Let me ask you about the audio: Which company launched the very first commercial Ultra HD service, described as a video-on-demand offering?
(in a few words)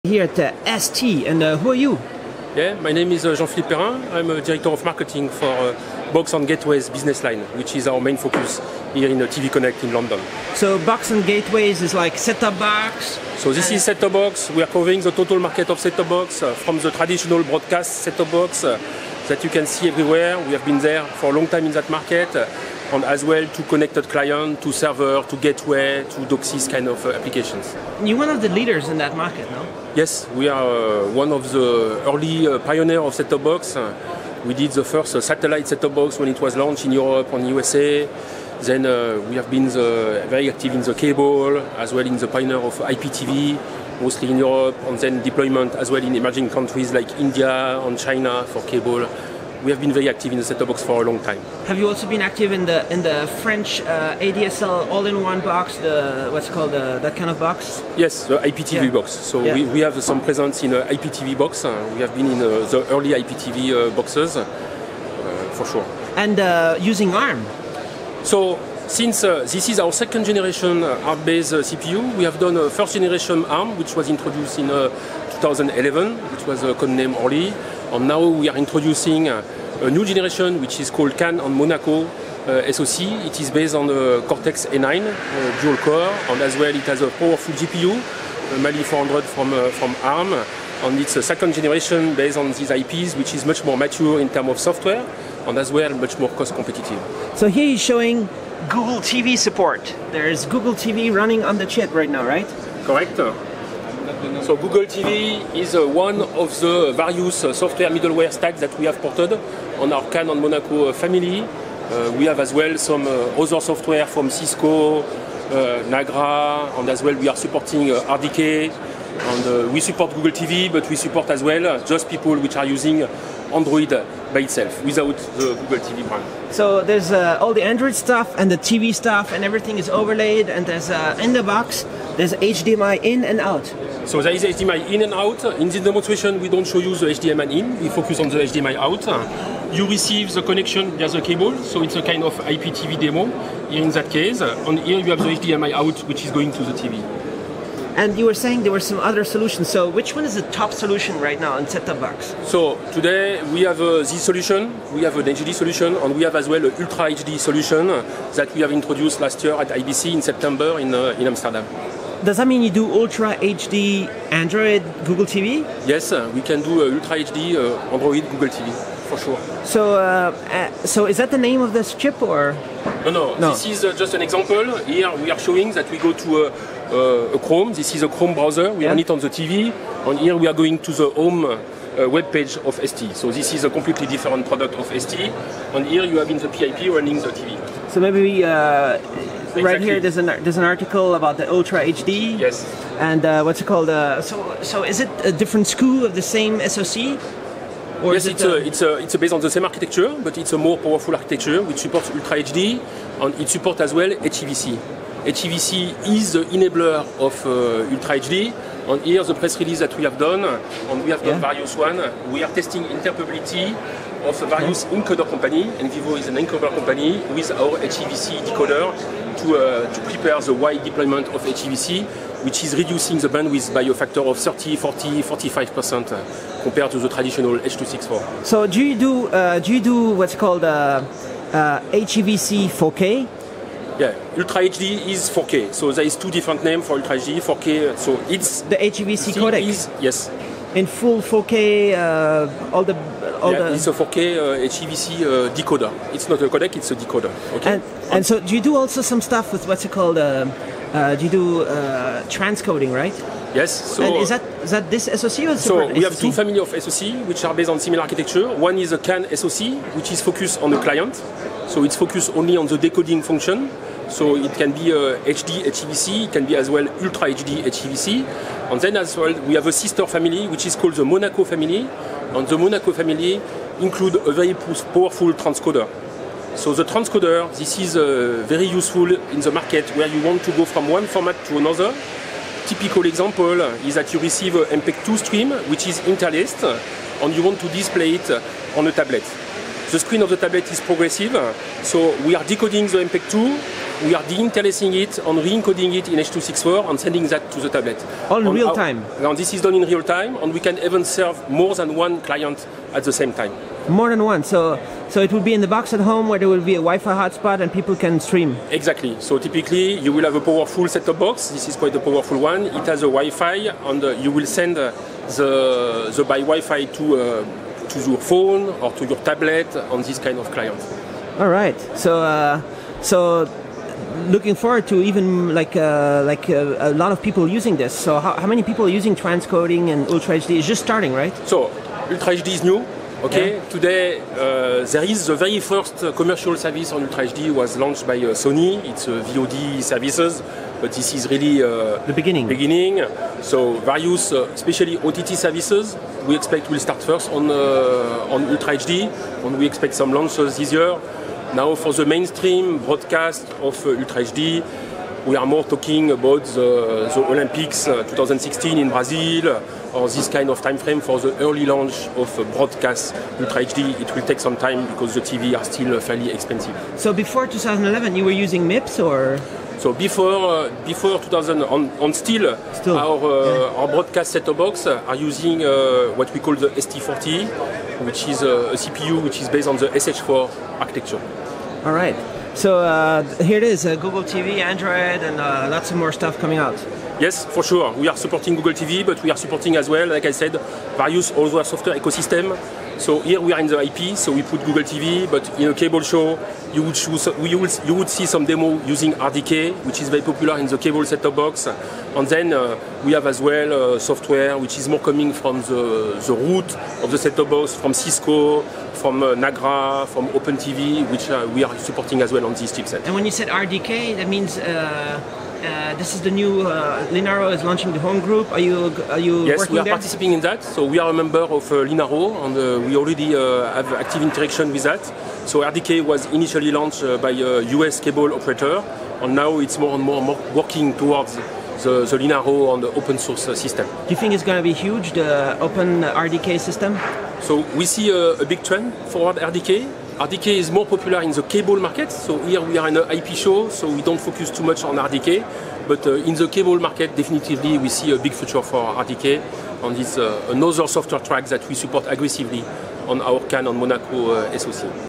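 Sony.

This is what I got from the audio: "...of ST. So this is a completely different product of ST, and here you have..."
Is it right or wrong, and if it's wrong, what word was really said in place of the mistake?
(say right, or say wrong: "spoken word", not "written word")
right.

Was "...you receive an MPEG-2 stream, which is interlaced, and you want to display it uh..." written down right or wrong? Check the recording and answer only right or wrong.
right.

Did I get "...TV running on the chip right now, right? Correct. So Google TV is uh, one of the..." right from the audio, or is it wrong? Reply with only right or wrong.
right.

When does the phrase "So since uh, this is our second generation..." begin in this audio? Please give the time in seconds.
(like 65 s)
68 s.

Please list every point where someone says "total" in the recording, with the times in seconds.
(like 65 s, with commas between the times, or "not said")
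15 s.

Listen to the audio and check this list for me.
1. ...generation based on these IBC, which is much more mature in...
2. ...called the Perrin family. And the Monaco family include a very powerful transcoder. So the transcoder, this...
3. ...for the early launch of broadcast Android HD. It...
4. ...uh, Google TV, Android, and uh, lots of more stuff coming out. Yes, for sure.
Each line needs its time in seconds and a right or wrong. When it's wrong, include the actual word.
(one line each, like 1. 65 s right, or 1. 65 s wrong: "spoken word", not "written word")
1. 91 s wrong: "IPs", not "IBC"
2. 270 s wrong: "Monaco", not "Perrin"
3. 361 s wrong: "Ultra", not "Android"
4. 383 s right.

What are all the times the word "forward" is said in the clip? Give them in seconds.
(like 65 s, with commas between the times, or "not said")
324 s, 439 s.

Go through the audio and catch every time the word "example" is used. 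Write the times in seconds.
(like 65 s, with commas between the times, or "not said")
174 s, 283 s.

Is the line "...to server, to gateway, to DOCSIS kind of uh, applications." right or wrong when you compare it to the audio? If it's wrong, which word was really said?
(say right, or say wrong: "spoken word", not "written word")
right.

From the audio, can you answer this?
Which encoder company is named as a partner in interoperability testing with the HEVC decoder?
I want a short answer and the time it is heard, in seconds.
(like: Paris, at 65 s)
Envivio, at 215 s.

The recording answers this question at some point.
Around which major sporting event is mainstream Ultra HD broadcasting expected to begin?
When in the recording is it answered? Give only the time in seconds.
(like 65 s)
357 s.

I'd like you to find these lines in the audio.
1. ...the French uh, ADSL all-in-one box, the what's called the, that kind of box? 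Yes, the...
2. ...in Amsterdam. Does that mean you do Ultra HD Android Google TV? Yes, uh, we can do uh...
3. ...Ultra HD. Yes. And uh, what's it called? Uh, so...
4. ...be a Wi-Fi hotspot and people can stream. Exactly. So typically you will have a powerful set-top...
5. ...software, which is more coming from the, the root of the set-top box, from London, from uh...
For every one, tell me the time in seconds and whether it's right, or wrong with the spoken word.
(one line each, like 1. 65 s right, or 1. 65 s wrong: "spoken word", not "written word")
1. 53 s right
2. 161 s right
3. 191 s right
4. 306 s right
5. 403 s wrong: "Cisco", not "London".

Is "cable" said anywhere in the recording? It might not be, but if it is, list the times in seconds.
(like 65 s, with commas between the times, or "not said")
40 s, 48 s, 141 s, 395 s, 400 s, 427 s, 441 s, 446 s.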